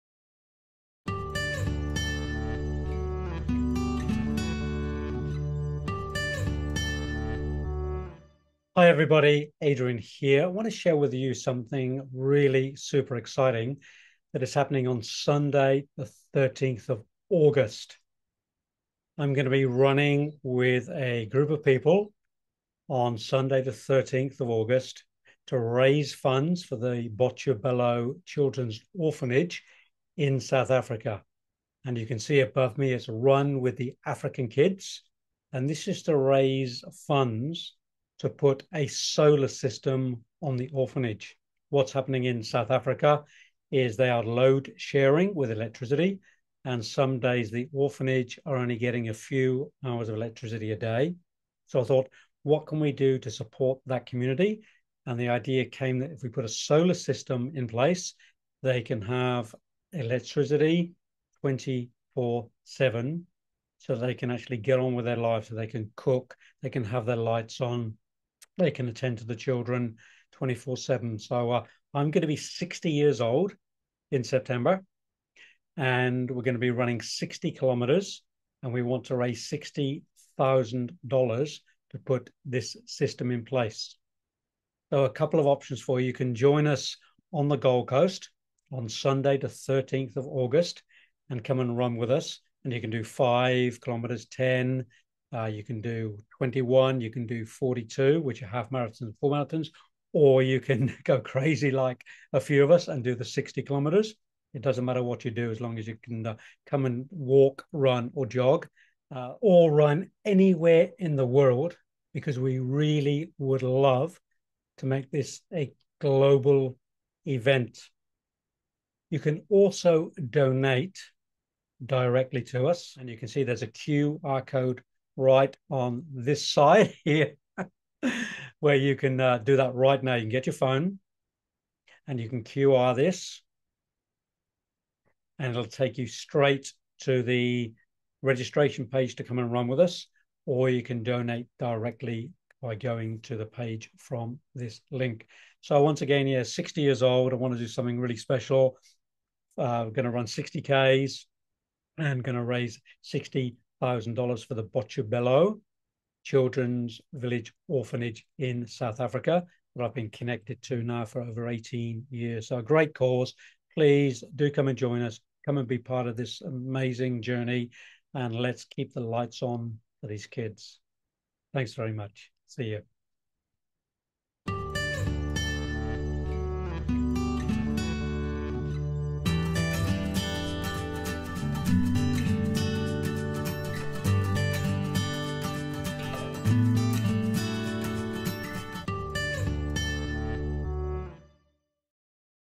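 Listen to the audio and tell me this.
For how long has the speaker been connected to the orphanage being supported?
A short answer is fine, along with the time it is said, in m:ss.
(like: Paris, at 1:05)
over 18 years, at 2:41.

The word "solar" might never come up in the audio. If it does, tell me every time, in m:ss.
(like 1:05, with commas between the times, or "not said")
0:38, 0:56.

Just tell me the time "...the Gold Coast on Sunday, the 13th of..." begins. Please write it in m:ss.
1:27.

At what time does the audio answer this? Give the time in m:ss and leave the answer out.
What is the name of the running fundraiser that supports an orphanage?
0:33.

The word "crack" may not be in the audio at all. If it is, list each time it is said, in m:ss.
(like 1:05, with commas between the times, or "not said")
not said.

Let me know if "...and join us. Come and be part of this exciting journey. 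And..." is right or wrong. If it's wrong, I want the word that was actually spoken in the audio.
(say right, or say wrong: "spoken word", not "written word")
wrong: "amazing", not "exciting".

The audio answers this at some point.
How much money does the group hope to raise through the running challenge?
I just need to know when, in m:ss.
1:19.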